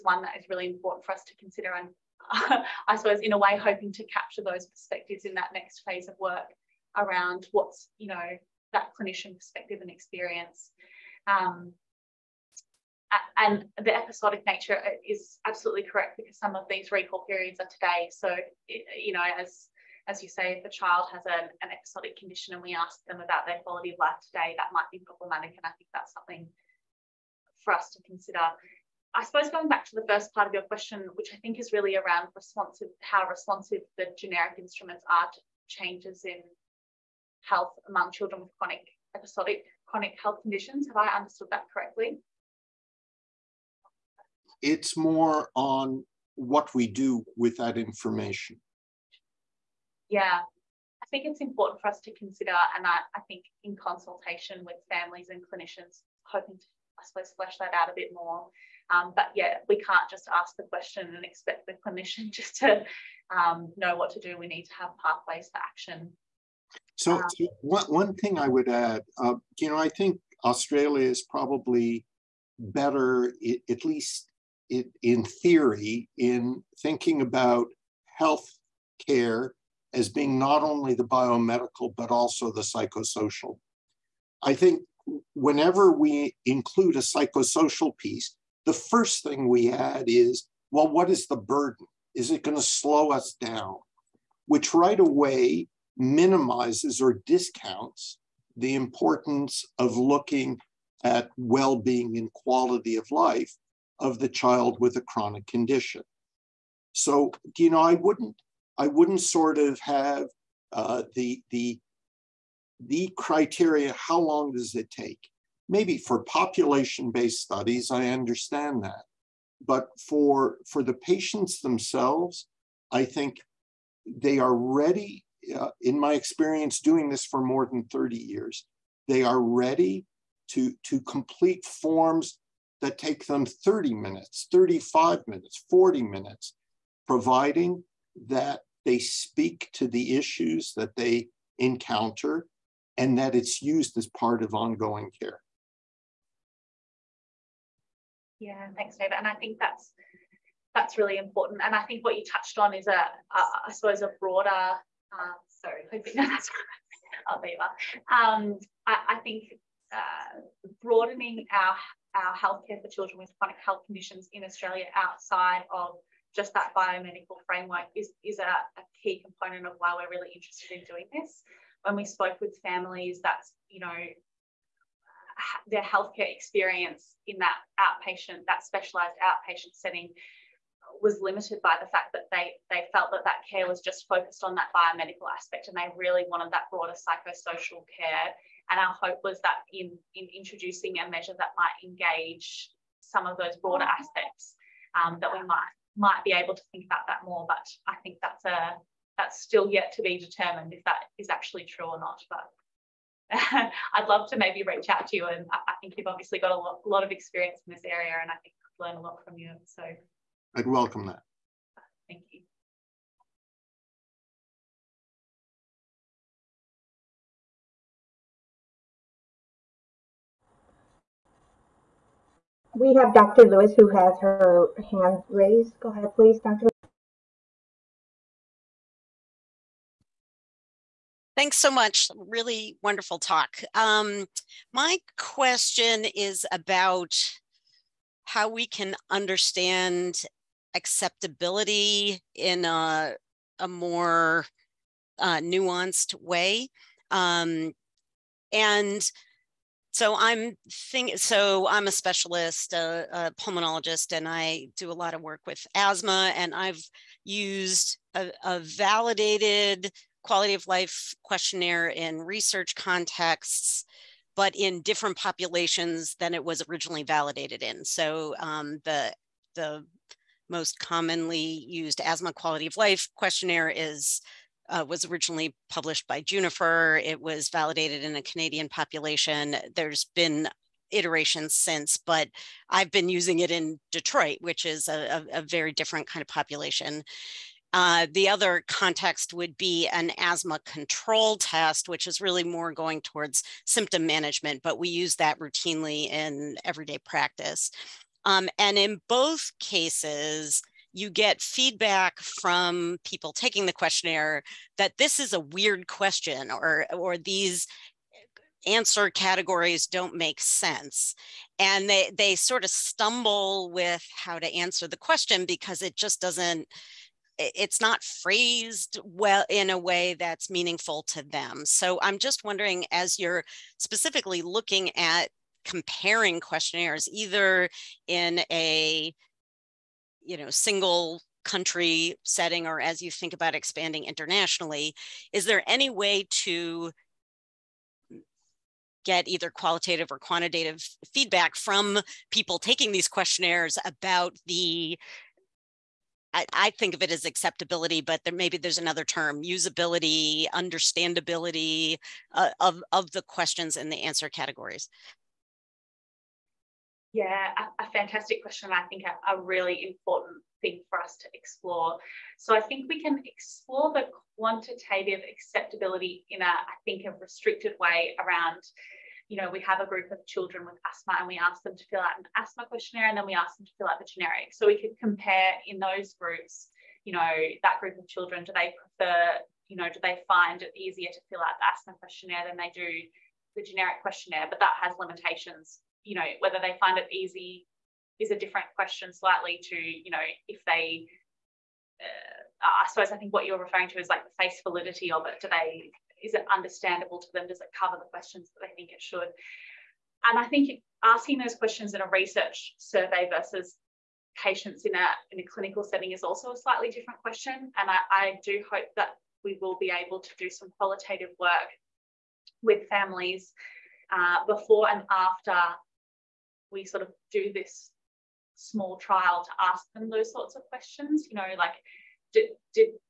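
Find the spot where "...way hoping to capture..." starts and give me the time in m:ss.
0:03.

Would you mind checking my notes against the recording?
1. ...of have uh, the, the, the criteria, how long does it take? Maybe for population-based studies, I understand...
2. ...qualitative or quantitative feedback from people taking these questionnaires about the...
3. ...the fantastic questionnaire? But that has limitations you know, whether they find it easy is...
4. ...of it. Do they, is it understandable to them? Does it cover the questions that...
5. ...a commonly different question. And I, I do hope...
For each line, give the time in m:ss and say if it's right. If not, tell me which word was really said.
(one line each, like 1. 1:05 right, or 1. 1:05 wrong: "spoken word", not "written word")
1. 1:49 right
2. 5:39 right
3. 6:23 wrong: "generic", not "fantastic"
4. 6:35 right
5. 6:46 wrong: "slightly", not "commonly".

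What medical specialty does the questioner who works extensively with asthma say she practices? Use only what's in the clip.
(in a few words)
pulmonologist.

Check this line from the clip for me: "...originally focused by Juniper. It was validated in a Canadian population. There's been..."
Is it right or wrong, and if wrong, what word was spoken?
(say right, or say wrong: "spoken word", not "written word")
wrong: "published", not "focused".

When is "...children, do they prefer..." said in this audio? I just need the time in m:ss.
6:18.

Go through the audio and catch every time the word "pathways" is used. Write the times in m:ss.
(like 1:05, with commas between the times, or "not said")
1:05.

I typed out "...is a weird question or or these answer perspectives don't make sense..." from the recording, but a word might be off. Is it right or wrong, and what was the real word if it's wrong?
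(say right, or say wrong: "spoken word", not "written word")
wrong: "categories", not "perspectives".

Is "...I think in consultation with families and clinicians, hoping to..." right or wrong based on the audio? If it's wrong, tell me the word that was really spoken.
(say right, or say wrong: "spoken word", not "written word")
right.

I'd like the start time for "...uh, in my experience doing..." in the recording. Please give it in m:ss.
2:05.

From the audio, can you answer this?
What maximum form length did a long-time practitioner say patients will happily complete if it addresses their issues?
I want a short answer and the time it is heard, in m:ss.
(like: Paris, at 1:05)
40 minutes, at 2:15.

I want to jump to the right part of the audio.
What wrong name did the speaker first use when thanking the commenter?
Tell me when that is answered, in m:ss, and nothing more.
2:28.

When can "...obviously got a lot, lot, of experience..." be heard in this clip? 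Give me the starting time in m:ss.
3:26.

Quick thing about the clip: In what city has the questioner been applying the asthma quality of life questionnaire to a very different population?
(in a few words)
Detroit.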